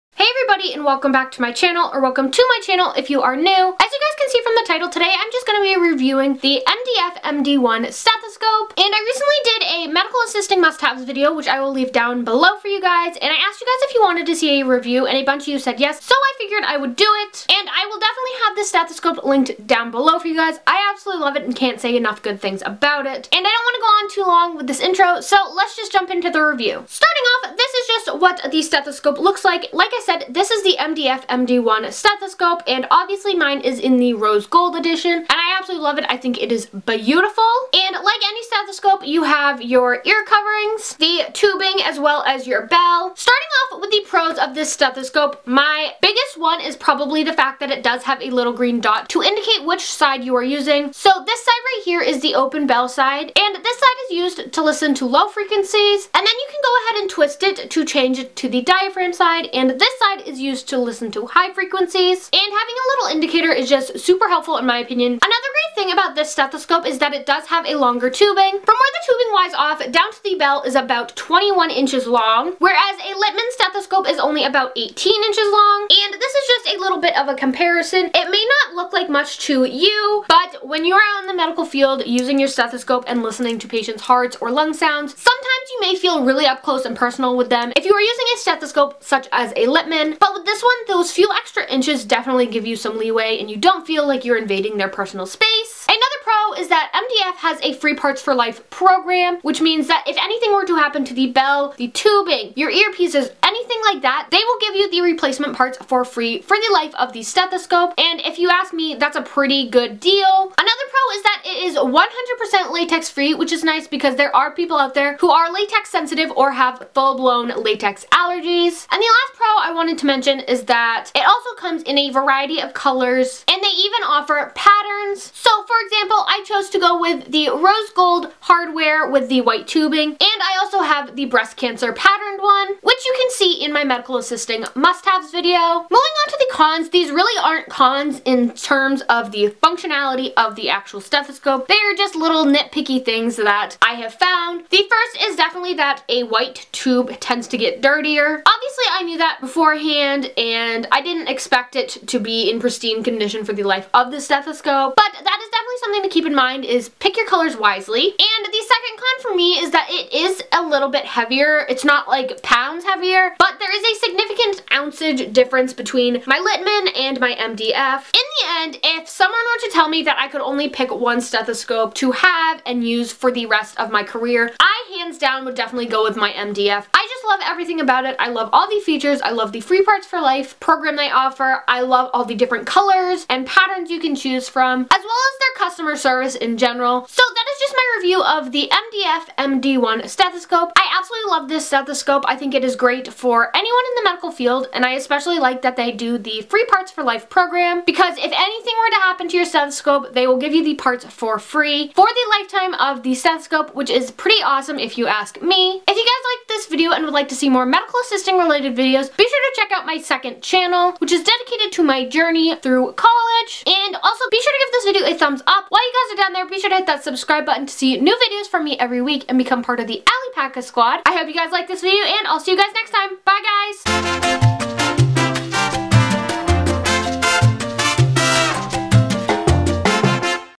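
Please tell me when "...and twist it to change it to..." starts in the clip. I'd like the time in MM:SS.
00:57.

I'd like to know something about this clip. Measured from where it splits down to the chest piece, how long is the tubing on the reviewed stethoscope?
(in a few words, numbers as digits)
21 inches.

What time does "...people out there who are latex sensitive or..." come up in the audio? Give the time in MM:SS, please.
01:54.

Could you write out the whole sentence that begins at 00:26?
Starting off, this is just what the stethoscope looks like.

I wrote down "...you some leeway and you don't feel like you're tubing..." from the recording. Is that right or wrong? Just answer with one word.
wrong.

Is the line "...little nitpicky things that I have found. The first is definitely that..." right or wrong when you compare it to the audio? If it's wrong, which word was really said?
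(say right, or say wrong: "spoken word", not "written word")
right.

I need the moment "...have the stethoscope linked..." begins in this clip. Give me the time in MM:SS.
00:18.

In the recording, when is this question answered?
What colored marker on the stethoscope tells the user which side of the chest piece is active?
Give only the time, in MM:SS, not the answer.
00:48.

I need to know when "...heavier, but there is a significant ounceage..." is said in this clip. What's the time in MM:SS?
02:42.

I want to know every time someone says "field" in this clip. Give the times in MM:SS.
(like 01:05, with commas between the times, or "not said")
01:21, 03:14.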